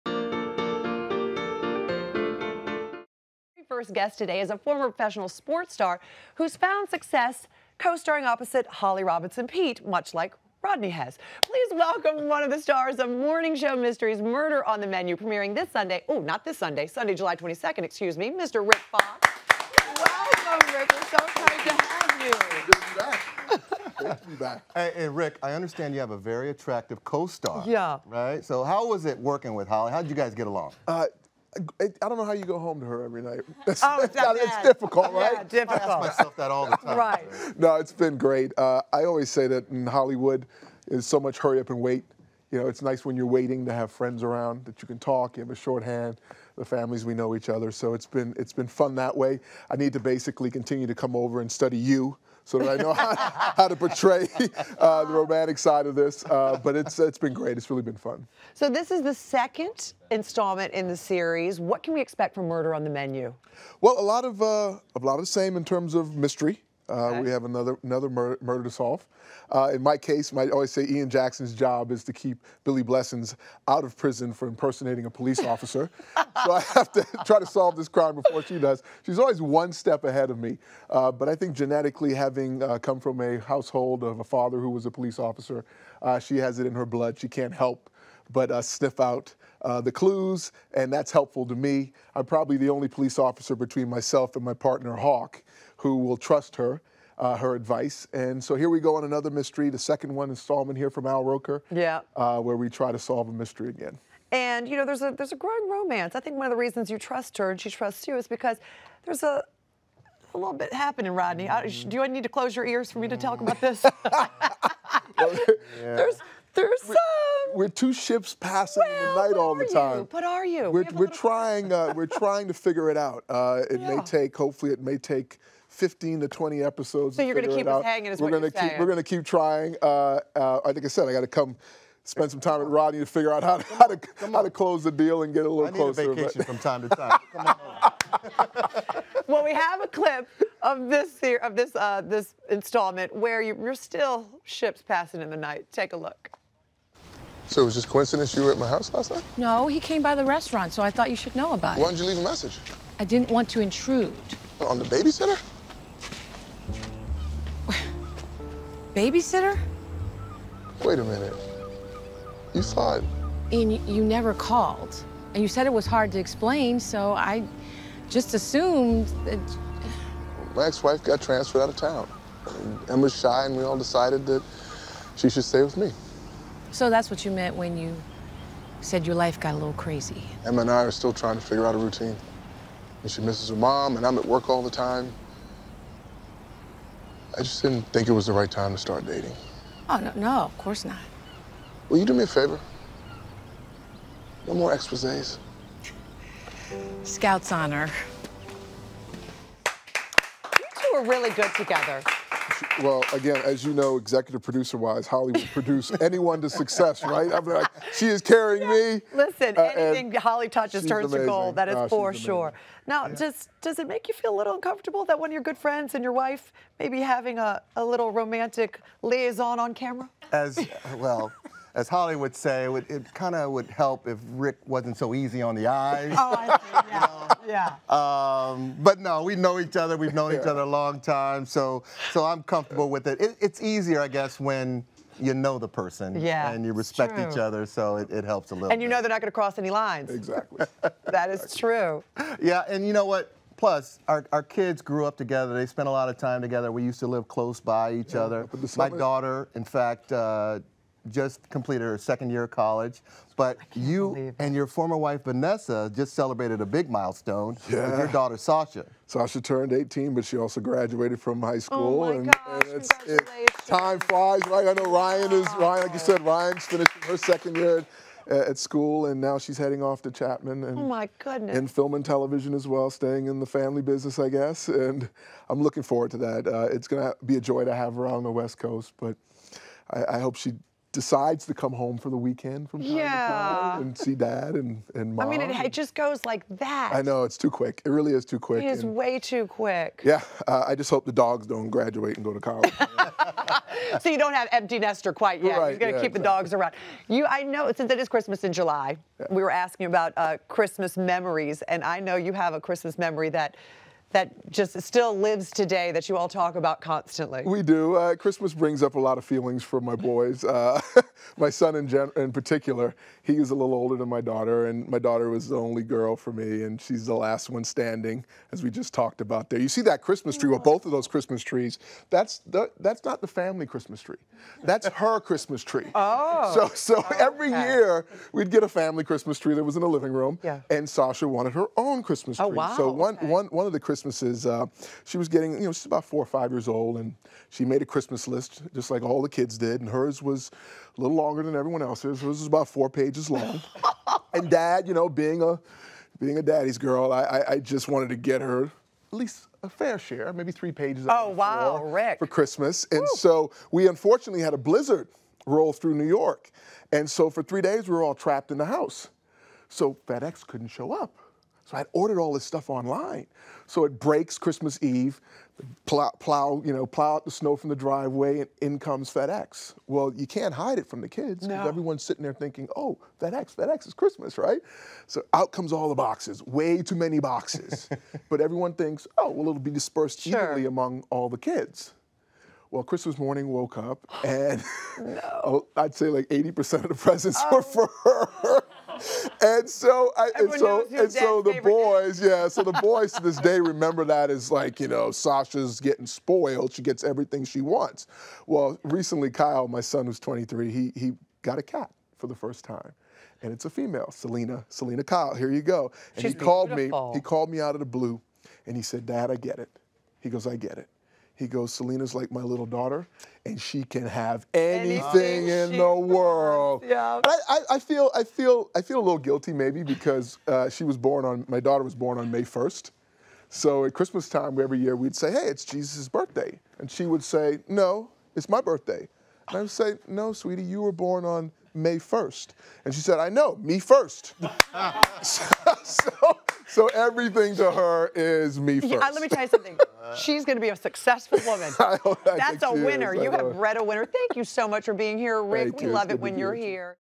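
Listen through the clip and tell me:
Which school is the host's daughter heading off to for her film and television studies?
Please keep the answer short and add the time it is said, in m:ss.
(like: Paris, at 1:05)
Chapman, at 4:30.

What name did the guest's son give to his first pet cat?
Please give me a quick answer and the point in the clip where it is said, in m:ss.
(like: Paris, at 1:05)
Selina Kyle, at 6:44.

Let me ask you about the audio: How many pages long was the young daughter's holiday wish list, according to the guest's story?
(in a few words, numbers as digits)
4.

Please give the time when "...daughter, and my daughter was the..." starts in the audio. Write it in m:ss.
5:14.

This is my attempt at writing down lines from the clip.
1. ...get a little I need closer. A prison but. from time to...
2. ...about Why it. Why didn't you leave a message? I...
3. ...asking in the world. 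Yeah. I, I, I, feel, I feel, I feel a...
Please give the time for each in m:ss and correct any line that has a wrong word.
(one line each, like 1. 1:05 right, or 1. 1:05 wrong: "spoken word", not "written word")
1. 2:15 wrong: "vacation", not "prison"
2. 2:31 right
3. 6:54 wrong: "anything", not "asking".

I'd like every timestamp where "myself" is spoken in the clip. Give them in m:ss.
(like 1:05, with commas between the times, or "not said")
0:36, 1:33.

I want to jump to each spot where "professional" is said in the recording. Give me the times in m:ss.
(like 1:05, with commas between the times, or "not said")
0:04.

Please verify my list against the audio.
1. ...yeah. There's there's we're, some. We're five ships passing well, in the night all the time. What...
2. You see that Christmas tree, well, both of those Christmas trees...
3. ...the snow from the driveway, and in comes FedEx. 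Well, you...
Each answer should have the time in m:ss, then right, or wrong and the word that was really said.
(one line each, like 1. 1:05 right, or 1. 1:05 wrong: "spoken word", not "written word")
1. 1:54 wrong: "two", not "five"
2. 5:19 right
3. 6:07 right.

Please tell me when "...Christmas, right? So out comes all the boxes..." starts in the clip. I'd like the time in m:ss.
6:13.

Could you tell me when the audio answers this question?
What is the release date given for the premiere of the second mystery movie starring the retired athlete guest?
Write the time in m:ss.
0:17.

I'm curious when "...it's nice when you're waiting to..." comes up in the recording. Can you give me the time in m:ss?
0:42.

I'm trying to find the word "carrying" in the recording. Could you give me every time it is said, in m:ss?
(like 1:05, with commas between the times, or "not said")
3:28.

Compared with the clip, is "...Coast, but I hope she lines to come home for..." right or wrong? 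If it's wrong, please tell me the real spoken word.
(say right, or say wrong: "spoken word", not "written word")
wrong: "decides", not "lines".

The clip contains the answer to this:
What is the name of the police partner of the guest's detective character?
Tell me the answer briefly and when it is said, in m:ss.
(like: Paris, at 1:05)
Hawk, at 1:34.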